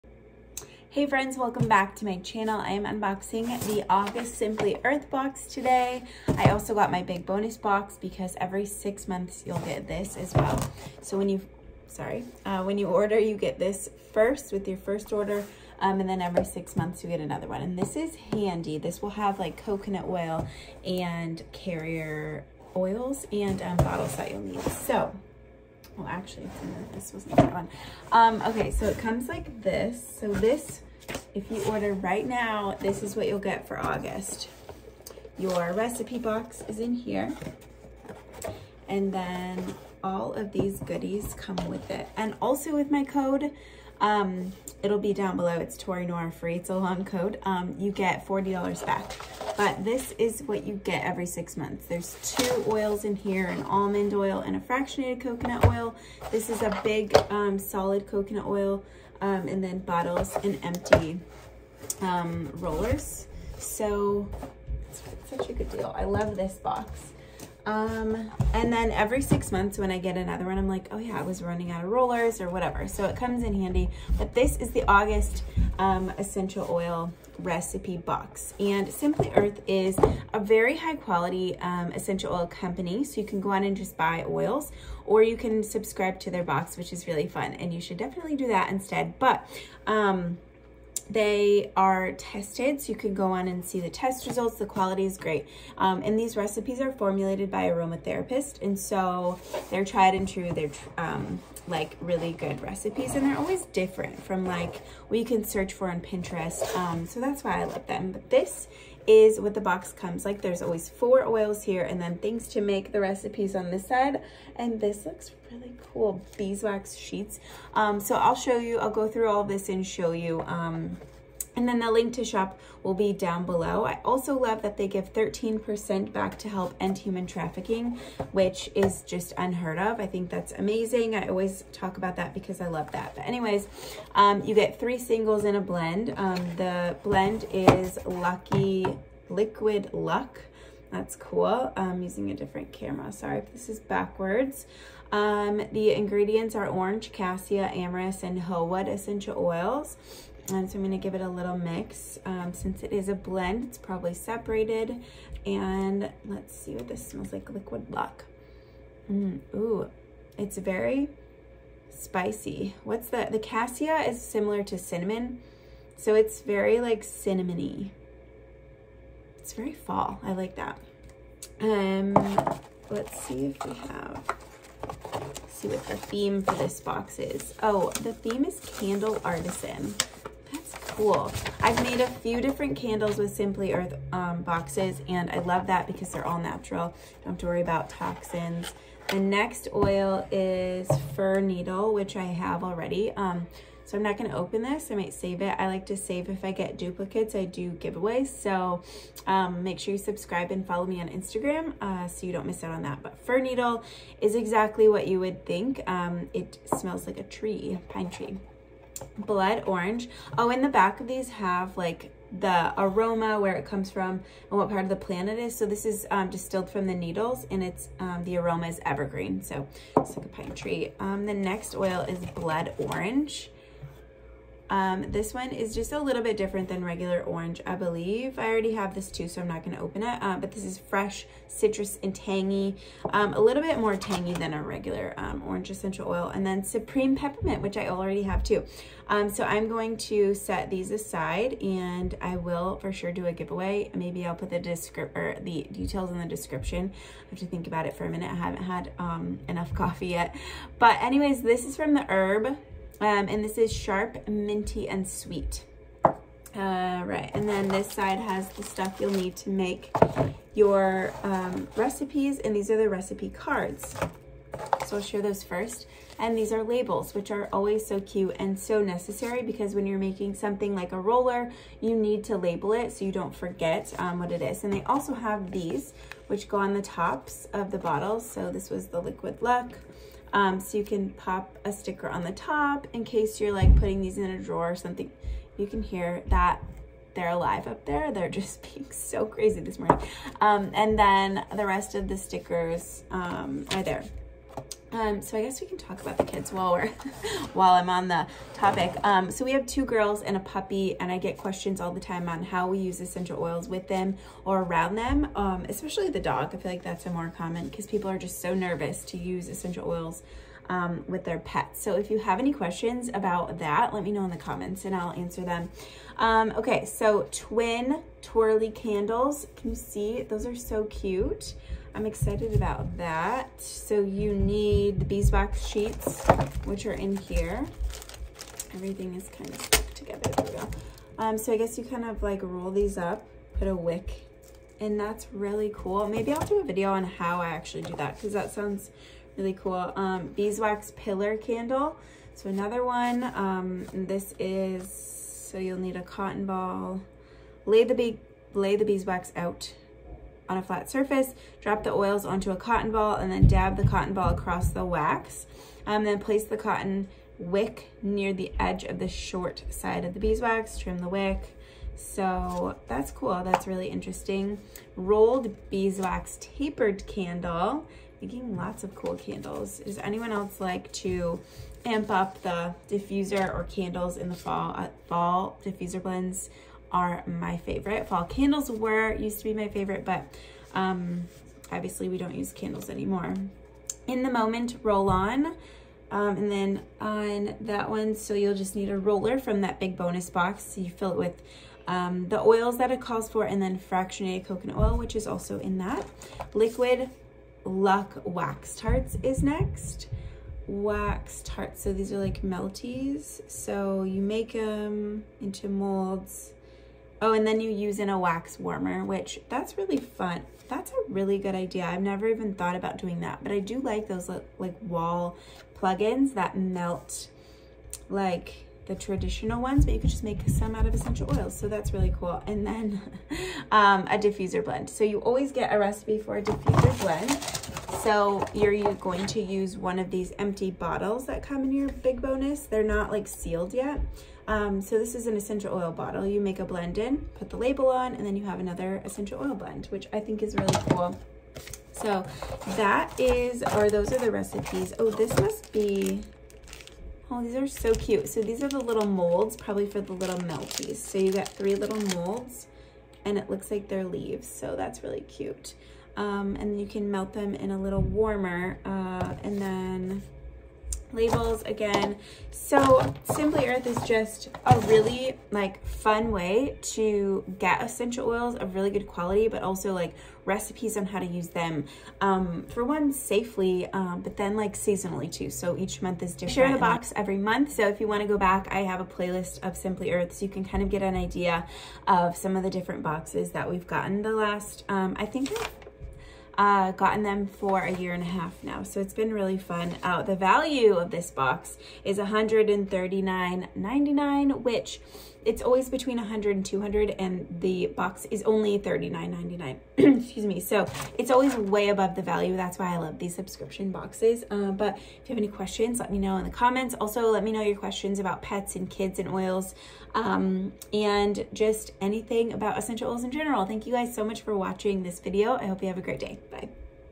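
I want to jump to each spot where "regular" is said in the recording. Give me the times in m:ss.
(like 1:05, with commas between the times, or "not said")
3:46, 3:54.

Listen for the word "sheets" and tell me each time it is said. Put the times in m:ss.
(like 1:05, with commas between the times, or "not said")
1:56, 5:25.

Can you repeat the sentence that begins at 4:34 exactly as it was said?
And they also have these, which go on the tops of the bottles.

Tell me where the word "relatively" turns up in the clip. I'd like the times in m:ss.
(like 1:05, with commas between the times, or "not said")
not said.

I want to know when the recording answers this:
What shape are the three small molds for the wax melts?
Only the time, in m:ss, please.
7:34.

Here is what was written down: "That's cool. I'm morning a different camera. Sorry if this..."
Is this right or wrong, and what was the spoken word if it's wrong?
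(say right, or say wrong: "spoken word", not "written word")
wrong: "using", not "morning".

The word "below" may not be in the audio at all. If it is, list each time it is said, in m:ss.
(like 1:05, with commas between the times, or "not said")
0:45, 2:03.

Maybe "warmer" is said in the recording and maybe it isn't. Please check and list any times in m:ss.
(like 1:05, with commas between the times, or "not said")
6:48, 7:38.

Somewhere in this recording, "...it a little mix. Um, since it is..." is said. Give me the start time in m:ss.
2:31.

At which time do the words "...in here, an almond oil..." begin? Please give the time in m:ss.
0:53.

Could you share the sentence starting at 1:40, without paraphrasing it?
They're um, like really good recipes, and they're always different from like what you can search for on Pinterest.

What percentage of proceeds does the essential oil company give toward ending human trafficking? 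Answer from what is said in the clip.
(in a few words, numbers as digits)
13%.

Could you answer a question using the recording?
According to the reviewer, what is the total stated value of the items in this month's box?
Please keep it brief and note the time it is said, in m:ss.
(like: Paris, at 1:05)
$139.99, at 8:12.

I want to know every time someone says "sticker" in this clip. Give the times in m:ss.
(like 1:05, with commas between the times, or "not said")
4:41, 4:52.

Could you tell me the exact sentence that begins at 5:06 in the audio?
I feel like that's a more common because people are just so nervous to use essential oils um, with their pets.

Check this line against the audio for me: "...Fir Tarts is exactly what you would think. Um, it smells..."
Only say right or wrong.
wrong.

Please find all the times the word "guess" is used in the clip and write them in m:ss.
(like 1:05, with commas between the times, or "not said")
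4:55, 5:31.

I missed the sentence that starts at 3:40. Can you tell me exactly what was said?
Um, the next oil is blood orange.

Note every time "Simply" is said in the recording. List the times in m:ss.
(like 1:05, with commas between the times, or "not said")
0:04, 1:18, 3:03, 7:43, 7:59.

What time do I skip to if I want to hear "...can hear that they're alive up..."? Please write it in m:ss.
4:45.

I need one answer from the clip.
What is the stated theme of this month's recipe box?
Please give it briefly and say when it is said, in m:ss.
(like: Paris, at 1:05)
Candle Artisan, at 2:58.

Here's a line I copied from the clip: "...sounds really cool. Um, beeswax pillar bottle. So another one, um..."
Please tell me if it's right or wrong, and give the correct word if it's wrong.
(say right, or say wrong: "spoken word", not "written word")
wrong: "candle", not "bottle".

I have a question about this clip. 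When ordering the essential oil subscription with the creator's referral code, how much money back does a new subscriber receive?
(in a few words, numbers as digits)
$40.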